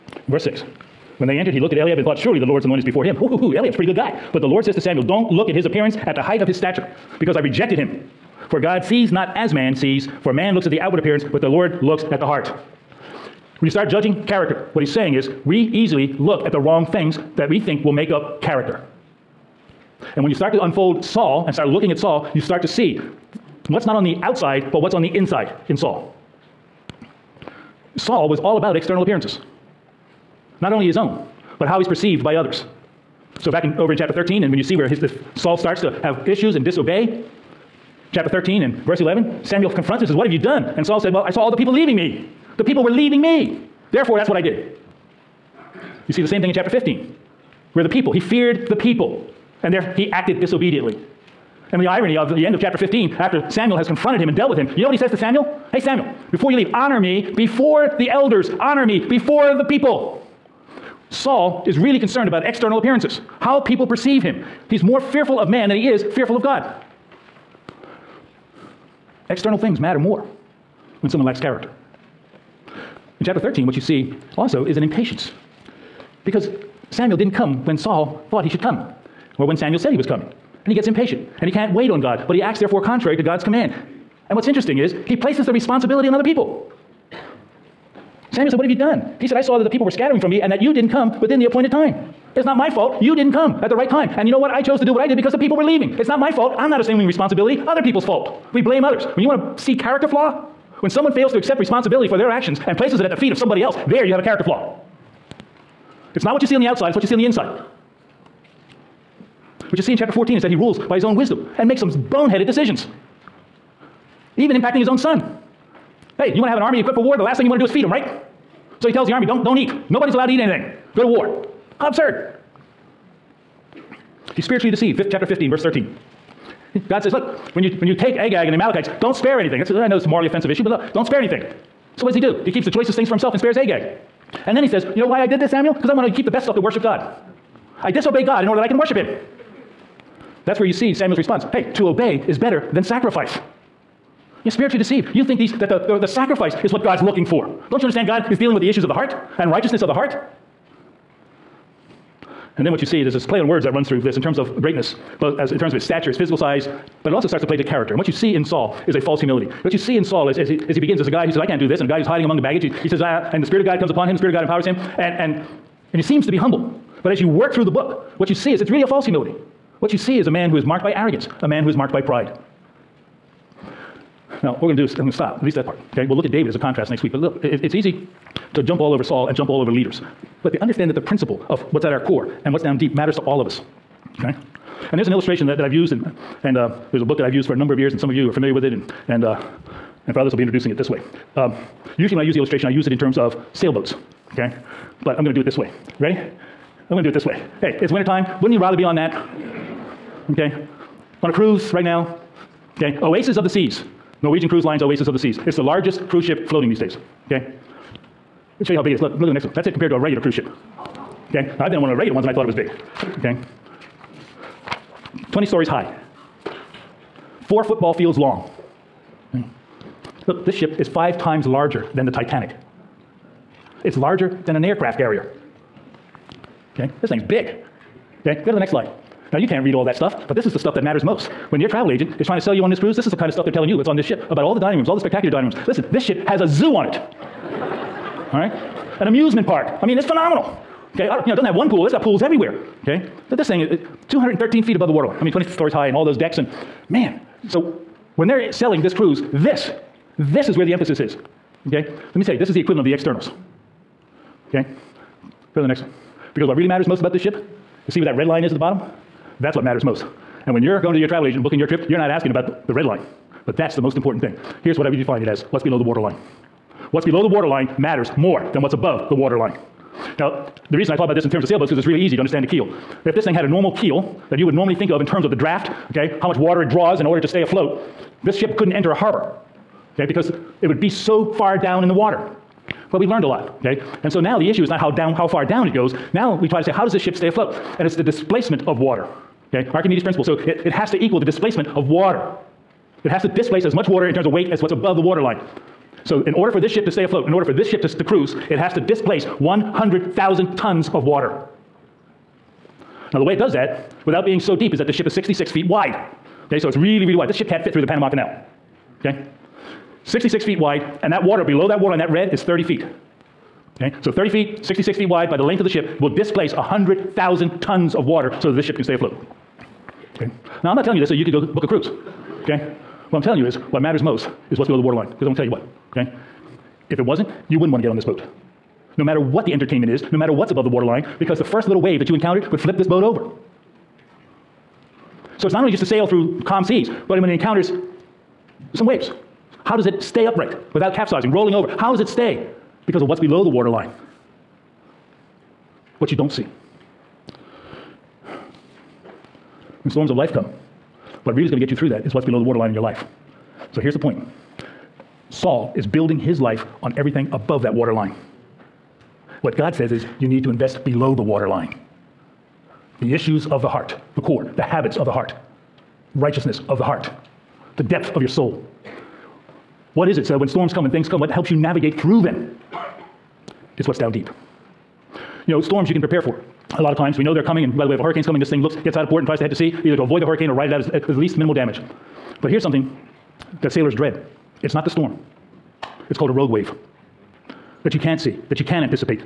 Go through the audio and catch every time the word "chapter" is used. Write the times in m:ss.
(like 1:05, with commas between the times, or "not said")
0:33, 0:38, 0:46, 0:52, 1:13, 1:49, 2:05.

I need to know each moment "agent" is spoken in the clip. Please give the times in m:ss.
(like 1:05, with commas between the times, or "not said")
3:51, 4:21.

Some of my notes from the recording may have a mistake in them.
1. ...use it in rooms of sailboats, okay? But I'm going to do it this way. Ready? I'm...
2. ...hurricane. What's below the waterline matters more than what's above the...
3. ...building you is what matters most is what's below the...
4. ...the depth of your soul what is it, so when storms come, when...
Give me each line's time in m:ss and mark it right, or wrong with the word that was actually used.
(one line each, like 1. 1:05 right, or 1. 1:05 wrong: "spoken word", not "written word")
1. 3:12 wrong: "terms", not "rooms"
2. 4:25 wrong: "waterline", not "hurricane"
3. 5:23 wrong: "telling", not "building"
4. 6:07 right.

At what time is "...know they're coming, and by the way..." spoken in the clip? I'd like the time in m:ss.
6:17.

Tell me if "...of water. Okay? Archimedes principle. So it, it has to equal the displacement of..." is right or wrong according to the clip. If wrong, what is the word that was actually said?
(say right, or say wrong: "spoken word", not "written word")
right.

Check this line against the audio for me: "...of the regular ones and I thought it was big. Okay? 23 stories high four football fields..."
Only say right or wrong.
wrong.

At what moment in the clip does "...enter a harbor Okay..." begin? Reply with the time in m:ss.
4:38.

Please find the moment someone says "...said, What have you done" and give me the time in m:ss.
1:28.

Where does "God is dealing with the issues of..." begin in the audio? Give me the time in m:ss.
2:28.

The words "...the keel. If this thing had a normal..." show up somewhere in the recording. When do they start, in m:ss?
4:32.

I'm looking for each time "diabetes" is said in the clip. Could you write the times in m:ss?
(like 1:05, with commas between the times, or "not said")
not said.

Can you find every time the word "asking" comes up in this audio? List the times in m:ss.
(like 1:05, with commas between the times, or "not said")
4:22.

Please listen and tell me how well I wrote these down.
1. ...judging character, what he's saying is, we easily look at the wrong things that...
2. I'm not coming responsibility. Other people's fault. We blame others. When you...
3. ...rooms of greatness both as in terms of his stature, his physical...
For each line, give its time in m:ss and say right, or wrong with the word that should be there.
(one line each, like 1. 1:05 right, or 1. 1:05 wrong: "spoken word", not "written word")
1. 0:13 right
2. 1:36 wrong: "assuming", not "coming"
3. 2:34 wrong: "terms", not "rooms".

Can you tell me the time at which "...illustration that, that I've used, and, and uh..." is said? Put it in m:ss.
3:05.